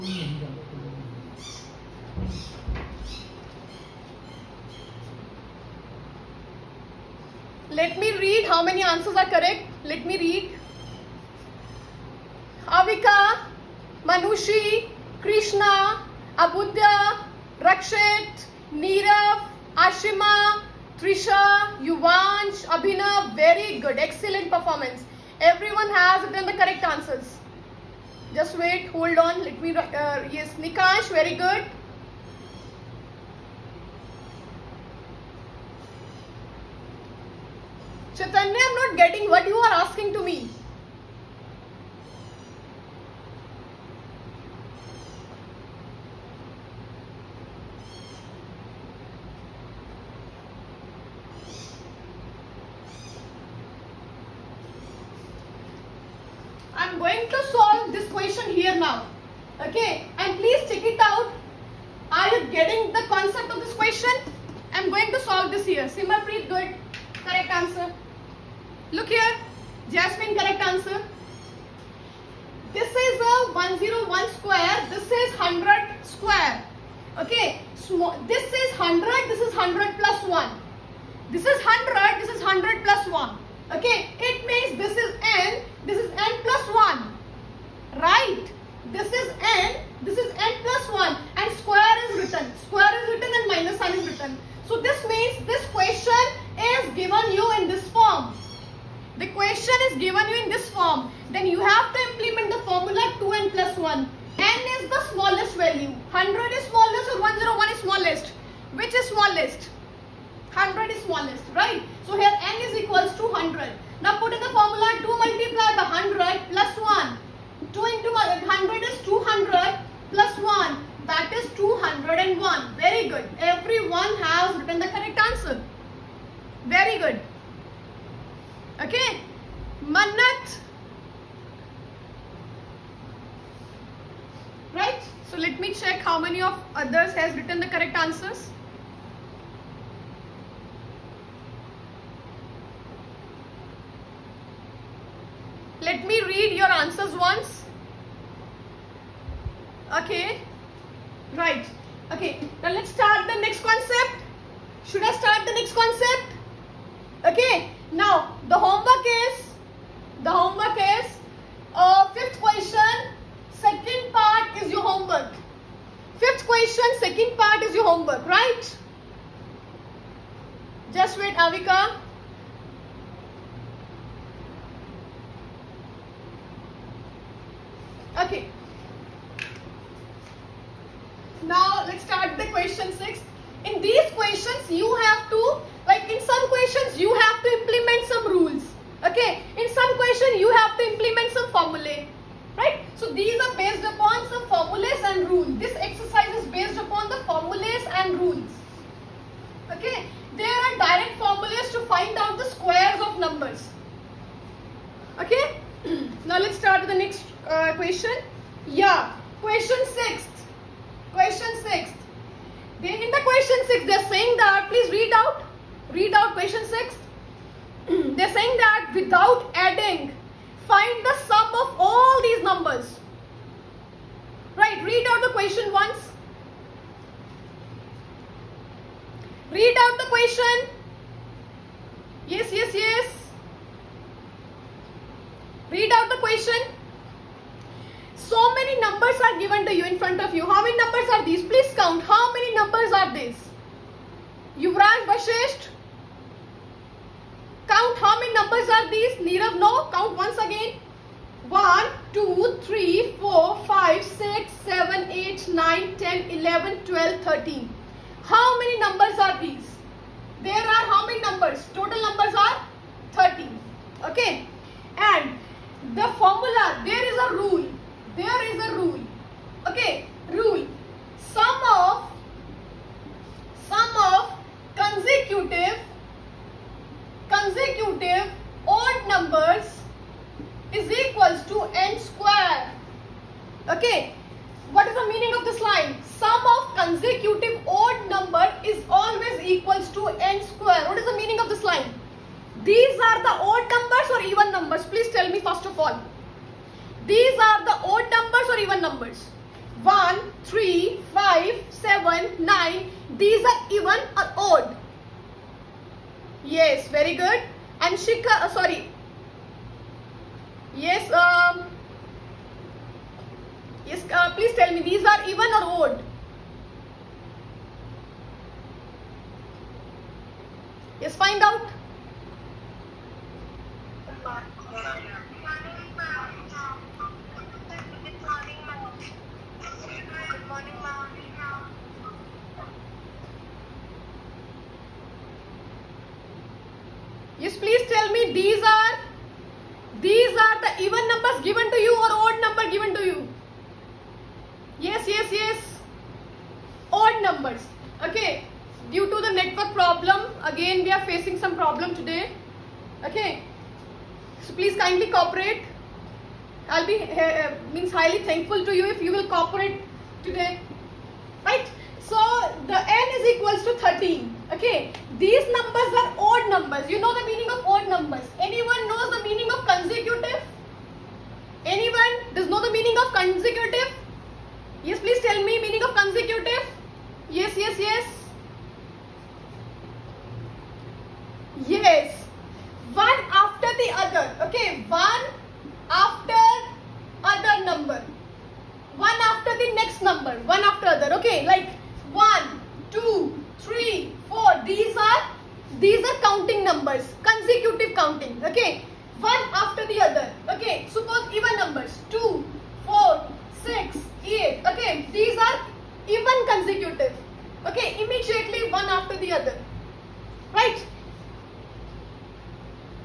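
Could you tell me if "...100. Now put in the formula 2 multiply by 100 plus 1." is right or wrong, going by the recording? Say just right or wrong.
right.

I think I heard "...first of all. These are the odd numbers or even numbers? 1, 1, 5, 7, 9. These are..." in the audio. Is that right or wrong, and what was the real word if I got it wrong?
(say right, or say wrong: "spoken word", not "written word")
wrong: "3", not "1".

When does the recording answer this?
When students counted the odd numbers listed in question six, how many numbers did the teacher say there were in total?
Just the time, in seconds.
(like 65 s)
261 s.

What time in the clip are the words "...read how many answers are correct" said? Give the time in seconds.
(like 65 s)
8 s.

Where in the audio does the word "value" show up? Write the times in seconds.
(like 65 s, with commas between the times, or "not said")
105 s.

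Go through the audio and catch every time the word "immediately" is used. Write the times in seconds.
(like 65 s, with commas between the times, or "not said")
408 s.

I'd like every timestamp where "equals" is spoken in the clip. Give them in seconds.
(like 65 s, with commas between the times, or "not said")
112 s, 289 s, 363 s.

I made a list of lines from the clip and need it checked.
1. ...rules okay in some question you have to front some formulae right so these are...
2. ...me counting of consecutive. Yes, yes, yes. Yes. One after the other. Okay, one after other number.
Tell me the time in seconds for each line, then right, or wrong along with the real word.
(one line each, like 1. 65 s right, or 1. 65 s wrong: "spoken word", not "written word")
1. 188 s wrong: "implement", not "front"
2. 375 s wrong: "meaning", not "counting".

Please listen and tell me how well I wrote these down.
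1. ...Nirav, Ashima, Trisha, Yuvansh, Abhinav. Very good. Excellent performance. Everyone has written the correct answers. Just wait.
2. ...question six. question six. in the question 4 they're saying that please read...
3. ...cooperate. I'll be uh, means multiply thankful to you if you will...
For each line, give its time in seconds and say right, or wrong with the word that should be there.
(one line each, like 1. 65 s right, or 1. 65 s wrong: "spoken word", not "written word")
1. 18 s right
2. 209 s wrong: "6", not "4"
3. 355 s wrong: "highly", not "multiply".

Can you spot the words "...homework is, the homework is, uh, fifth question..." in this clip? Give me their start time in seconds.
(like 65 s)
158 s.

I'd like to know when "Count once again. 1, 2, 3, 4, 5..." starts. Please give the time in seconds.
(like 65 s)
249 s.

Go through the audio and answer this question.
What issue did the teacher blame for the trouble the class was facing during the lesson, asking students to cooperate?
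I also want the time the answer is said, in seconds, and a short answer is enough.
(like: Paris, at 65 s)
Network problem, at 348 s.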